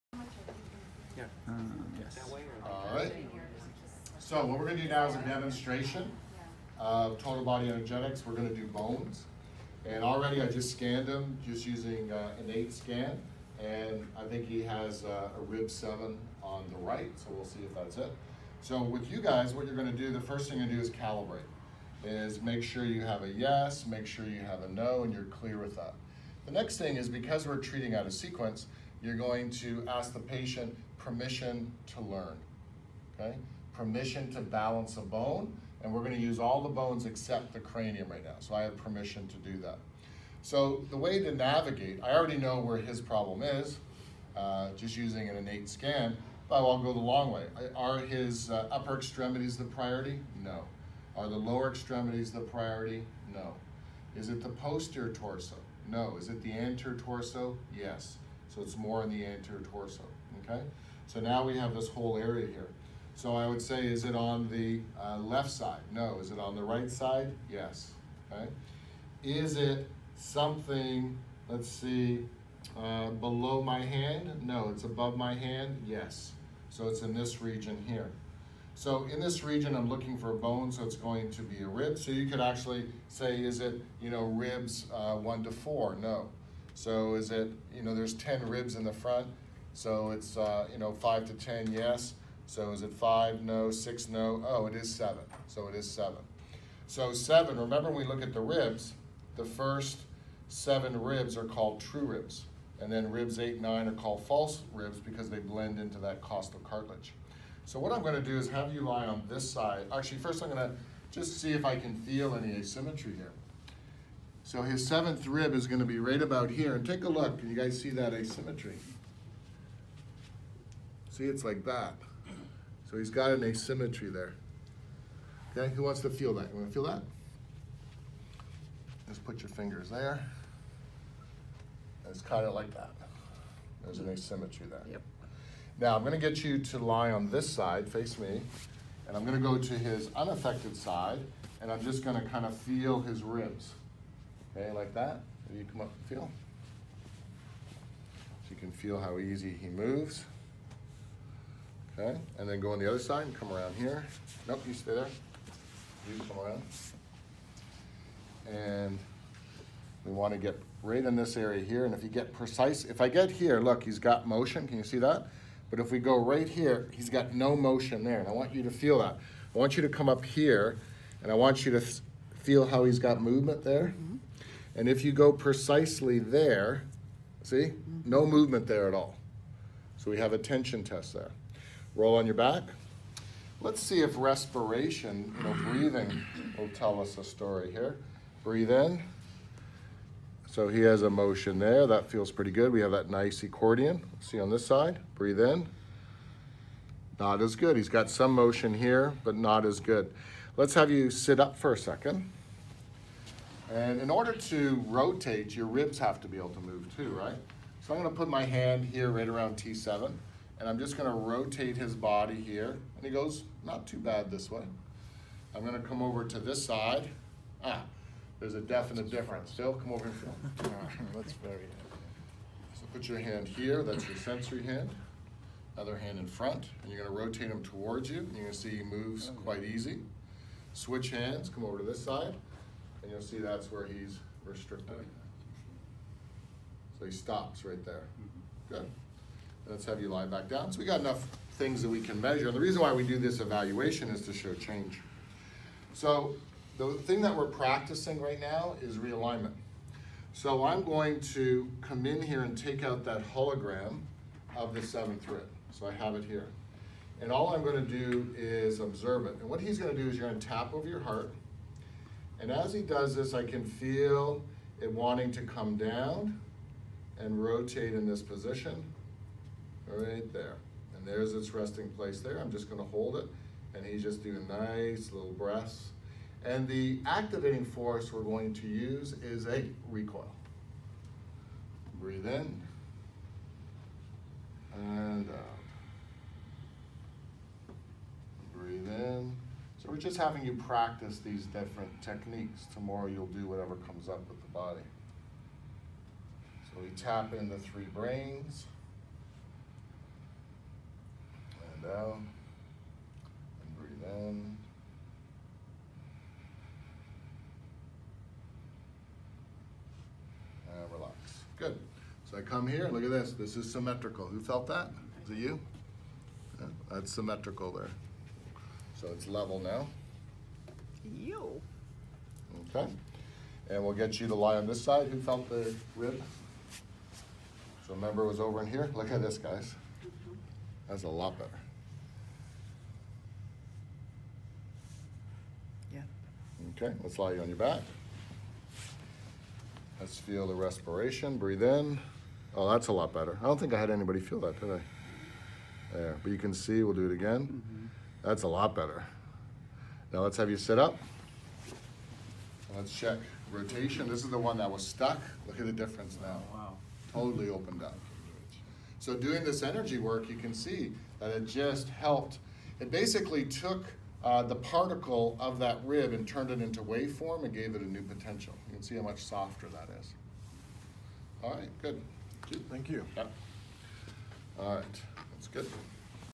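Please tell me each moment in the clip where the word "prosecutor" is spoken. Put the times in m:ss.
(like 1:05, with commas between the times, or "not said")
not said.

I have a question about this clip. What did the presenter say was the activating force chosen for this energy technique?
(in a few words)
recoil.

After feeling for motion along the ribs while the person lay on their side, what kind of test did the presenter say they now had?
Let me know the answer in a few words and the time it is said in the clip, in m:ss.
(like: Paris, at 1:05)
tension test, at 3:00.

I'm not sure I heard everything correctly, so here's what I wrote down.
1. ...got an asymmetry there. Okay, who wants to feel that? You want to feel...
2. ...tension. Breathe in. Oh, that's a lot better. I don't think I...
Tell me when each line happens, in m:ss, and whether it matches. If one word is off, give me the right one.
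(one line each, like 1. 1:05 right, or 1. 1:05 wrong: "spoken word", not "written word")
1. 2:03 right
2. 5:40 wrong: "respiration", not "tension".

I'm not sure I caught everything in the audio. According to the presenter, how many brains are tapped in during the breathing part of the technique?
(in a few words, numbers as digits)
3.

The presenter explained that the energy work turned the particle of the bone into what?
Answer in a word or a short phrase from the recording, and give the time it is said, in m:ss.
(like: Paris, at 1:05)
waveform, at 6:06.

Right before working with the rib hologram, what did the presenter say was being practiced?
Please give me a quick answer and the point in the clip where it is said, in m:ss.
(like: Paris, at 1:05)
realignment, at 4:08.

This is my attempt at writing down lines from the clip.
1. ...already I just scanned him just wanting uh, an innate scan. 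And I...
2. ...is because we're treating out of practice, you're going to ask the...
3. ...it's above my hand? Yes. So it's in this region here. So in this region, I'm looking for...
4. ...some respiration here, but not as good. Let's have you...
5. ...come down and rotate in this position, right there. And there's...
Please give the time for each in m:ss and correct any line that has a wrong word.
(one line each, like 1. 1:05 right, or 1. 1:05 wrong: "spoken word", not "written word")
1. 0:10 wrong: "using", not "wanting"
2. 0:26 wrong: "sequence", not "practice"
3. 1:14 right
4. 3:18 wrong: "motion", not "respiration"
5. 4:25 right.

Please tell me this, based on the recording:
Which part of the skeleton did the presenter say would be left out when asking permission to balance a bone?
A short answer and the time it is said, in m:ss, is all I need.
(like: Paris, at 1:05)
cranium, at 0:37.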